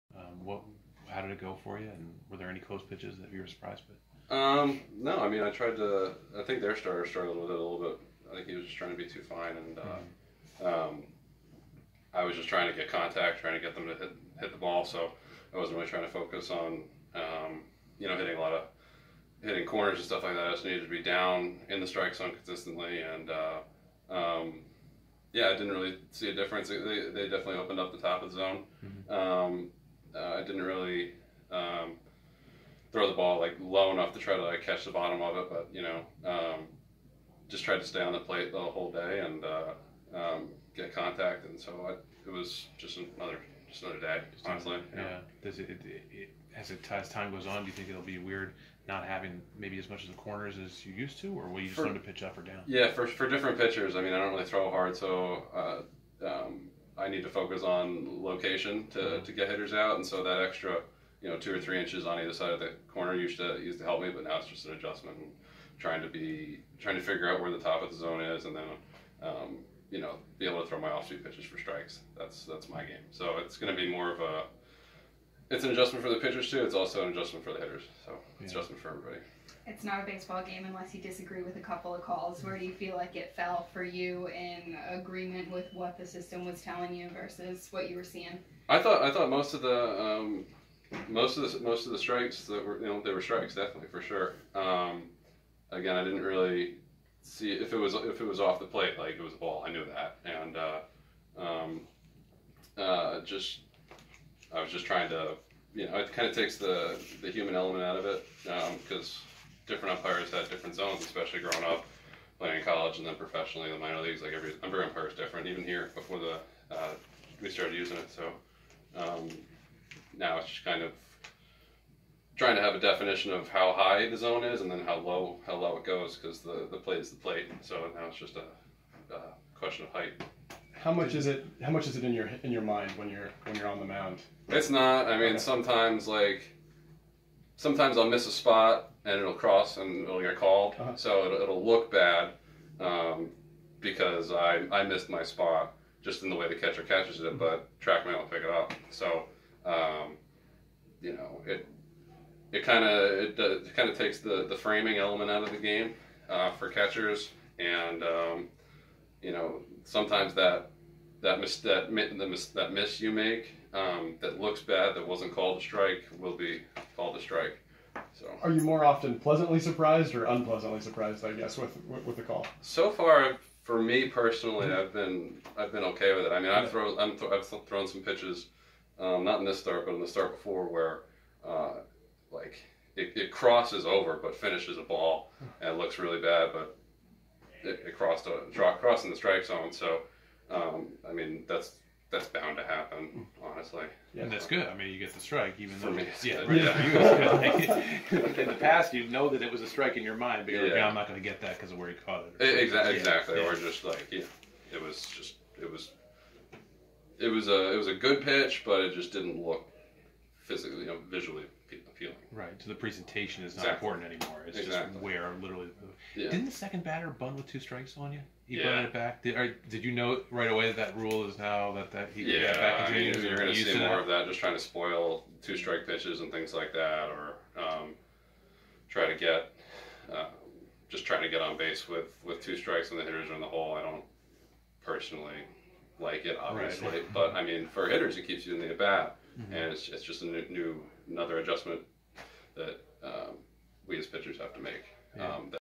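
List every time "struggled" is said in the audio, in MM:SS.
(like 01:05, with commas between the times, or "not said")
00:07.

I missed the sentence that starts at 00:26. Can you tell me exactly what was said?
They, they definitely opened up the top of the zone.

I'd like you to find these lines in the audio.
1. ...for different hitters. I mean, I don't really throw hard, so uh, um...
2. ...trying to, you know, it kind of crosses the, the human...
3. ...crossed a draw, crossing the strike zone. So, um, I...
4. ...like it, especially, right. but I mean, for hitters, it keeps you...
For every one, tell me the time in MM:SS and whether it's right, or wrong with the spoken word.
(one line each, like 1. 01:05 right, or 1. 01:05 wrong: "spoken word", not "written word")
1. 00:53 wrong: "pitchers", not "hitters"
2. 01:44 wrong: "takes", not "crosses"
3. 03:07 right
4. 03:56 wrong: "obviously", not "especially".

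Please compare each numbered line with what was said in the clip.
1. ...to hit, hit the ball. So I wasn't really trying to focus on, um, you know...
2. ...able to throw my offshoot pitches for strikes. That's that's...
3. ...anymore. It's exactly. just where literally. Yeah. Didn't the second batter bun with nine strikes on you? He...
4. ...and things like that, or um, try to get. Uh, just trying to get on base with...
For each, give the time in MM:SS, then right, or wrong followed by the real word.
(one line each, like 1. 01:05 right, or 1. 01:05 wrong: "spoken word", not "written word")
1. 00:13 right
2. 01:10 right
3. 03:34 wrong: "two", not "nine"
4. 03:46 right.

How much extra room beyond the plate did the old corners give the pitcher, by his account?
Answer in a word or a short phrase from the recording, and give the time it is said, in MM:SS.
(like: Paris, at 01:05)
2 or 3 inches, at 01:01.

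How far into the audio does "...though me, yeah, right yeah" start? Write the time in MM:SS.
03:15.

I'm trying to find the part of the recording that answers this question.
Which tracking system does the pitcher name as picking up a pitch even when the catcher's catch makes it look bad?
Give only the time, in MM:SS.
02:27.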